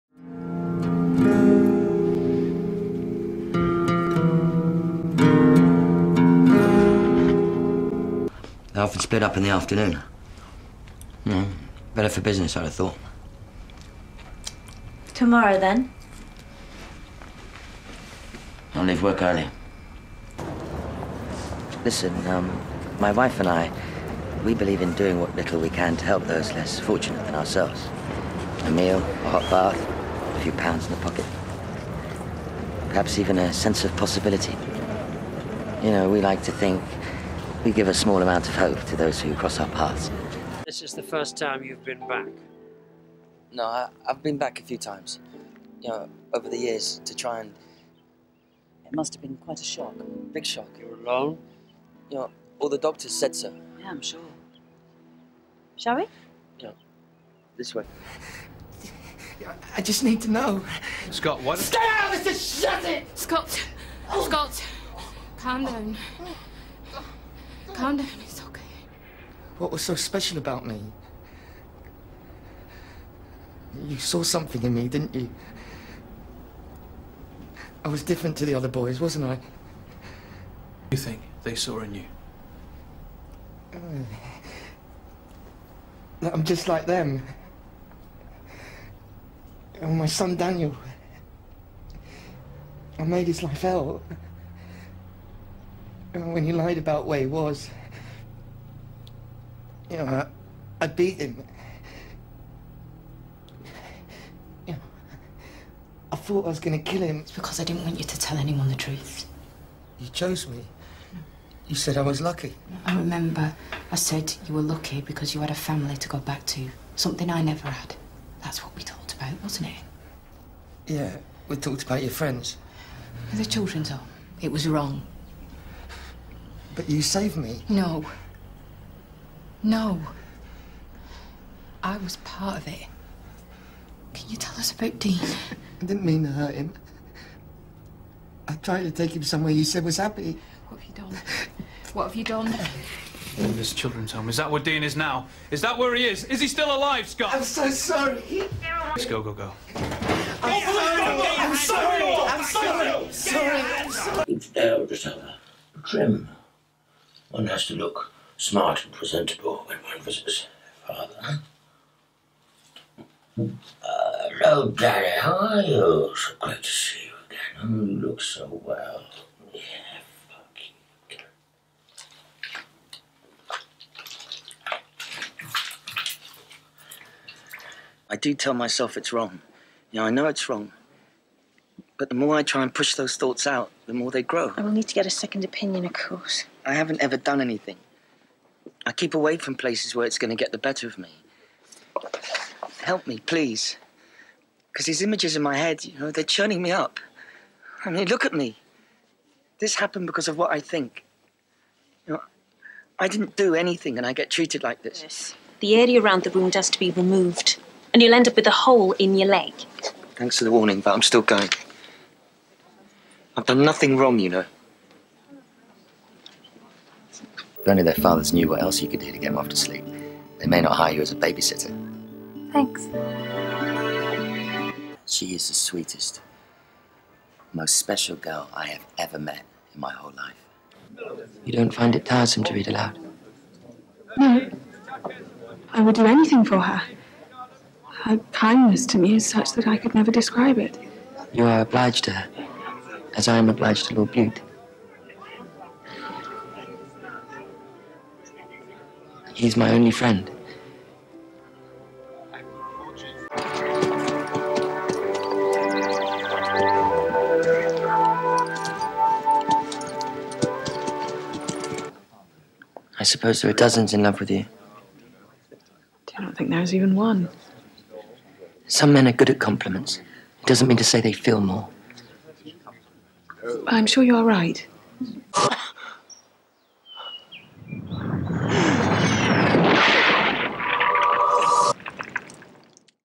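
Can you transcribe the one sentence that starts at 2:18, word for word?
I tried to take him somewhere you said was happy.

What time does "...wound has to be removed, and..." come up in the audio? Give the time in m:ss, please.
3:26.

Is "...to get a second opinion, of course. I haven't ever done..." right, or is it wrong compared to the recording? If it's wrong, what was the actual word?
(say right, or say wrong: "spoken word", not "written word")
right.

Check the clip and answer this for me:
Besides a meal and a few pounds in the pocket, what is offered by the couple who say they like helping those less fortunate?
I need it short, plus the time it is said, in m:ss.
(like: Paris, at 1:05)
A hot bath, at 0:28.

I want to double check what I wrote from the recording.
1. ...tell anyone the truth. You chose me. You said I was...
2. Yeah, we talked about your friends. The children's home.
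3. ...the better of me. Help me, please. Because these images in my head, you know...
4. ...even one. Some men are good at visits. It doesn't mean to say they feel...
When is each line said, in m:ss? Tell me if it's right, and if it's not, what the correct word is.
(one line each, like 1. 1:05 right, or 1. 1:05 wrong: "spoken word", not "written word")
1. 1:48 right
2. 2:00 right
3. 3:10 right
4. 4:26 wrong: "compliments", not "visits".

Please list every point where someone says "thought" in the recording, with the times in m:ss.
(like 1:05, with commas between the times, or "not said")
0:12, 1:46, 3:03.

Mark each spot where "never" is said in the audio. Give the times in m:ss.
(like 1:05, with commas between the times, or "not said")
1:57, 3:59.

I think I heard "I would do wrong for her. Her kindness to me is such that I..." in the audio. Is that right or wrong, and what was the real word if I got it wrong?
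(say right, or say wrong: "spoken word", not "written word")
wrong: "anything", not "wrong".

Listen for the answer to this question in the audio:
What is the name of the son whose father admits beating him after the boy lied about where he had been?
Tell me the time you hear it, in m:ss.
1:30.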